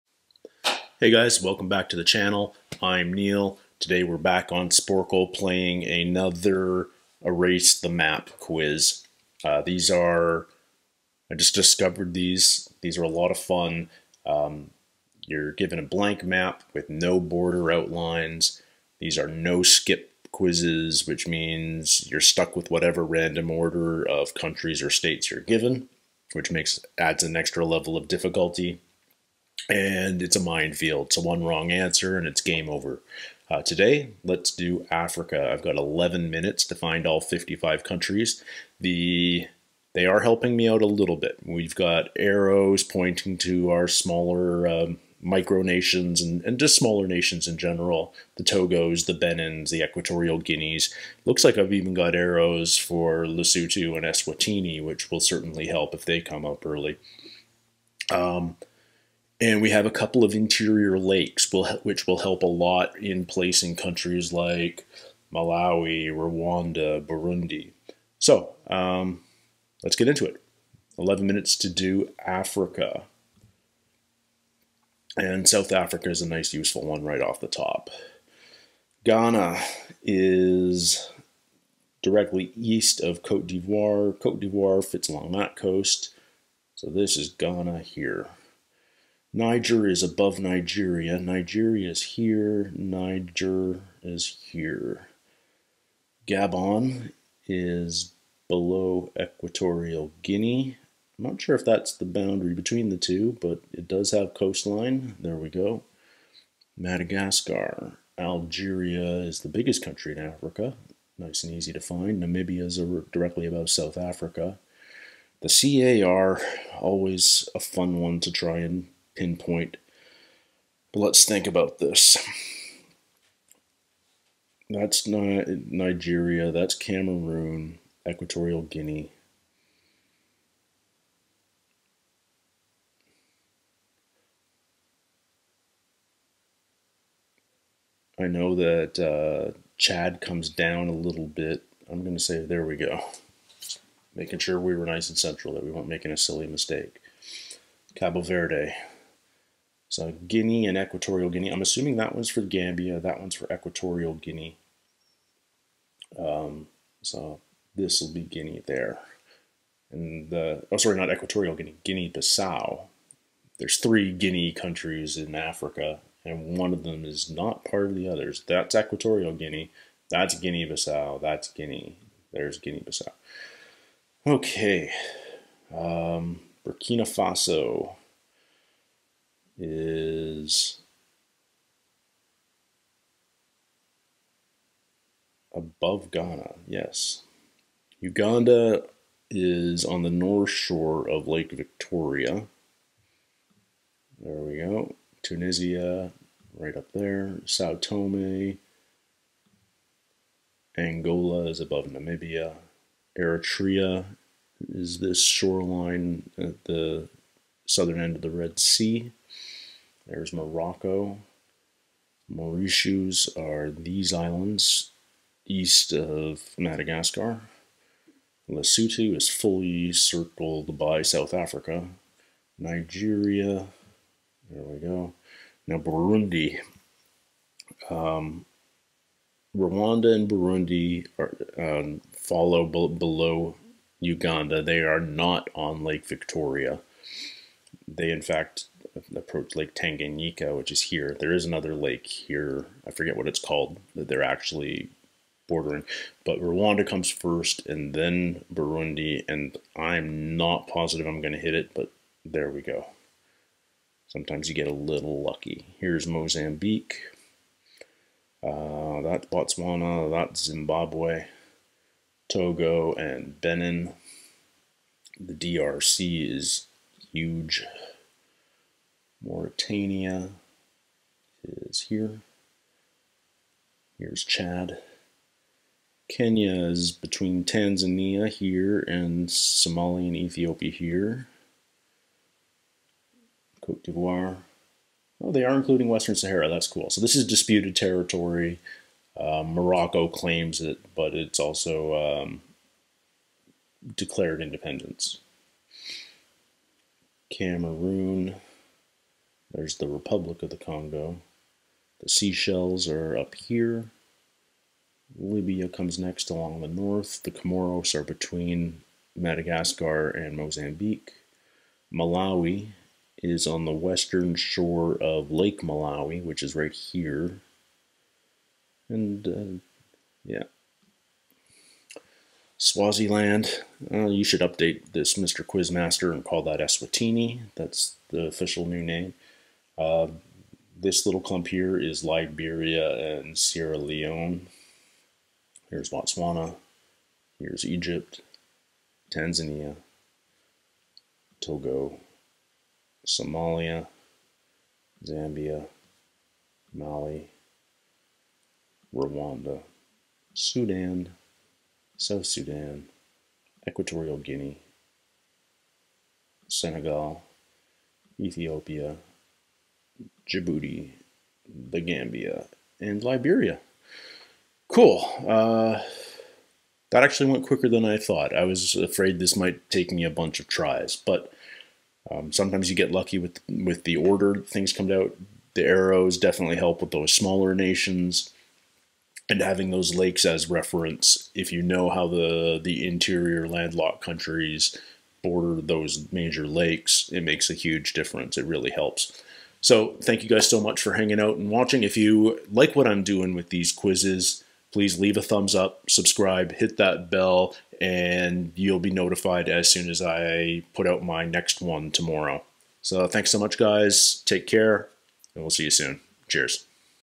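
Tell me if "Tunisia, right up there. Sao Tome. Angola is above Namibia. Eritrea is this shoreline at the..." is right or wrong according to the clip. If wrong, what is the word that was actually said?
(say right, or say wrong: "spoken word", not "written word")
right.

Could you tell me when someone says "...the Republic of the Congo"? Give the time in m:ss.
4:59.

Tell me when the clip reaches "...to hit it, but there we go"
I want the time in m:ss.
4:11.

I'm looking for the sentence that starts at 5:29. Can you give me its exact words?
Uh, this little clump here is Liberia and Sierra Leone.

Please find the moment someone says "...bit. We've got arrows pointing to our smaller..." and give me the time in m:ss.
0:41.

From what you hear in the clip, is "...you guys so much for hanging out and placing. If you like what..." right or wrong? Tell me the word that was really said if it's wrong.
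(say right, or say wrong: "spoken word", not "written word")
wrong: "watching", not "placing".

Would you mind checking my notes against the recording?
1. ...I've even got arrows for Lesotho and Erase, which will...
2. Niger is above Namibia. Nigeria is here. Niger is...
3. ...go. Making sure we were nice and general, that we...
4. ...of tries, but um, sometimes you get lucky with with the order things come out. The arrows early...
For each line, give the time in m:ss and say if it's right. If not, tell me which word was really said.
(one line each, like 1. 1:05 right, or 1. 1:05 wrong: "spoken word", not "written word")
1. 0:51 wrong: "Eswatini", not "Erase"
2. 1:29 wrong: "Nigeria", not "Namibia"
3. 2:22 wrong: "central", not "general"
4. 6:10 wrong: "definitely", not "early".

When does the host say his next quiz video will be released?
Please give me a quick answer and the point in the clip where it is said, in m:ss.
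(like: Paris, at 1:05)
Tomorrow, at 6:41.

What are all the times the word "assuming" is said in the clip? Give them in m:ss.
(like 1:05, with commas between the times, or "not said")
2:31.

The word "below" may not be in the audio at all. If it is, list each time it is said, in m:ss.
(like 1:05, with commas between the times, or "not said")
1:38, 3:52.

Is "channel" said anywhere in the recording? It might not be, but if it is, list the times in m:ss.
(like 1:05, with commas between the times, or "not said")
0:02.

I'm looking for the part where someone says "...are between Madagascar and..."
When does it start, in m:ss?
5:07.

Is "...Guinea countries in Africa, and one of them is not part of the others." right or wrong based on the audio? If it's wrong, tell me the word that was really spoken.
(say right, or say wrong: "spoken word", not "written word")
right.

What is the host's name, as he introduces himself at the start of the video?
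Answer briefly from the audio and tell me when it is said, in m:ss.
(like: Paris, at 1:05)
Neil, at 0:03.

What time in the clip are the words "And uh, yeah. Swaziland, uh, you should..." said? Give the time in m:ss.
5:18.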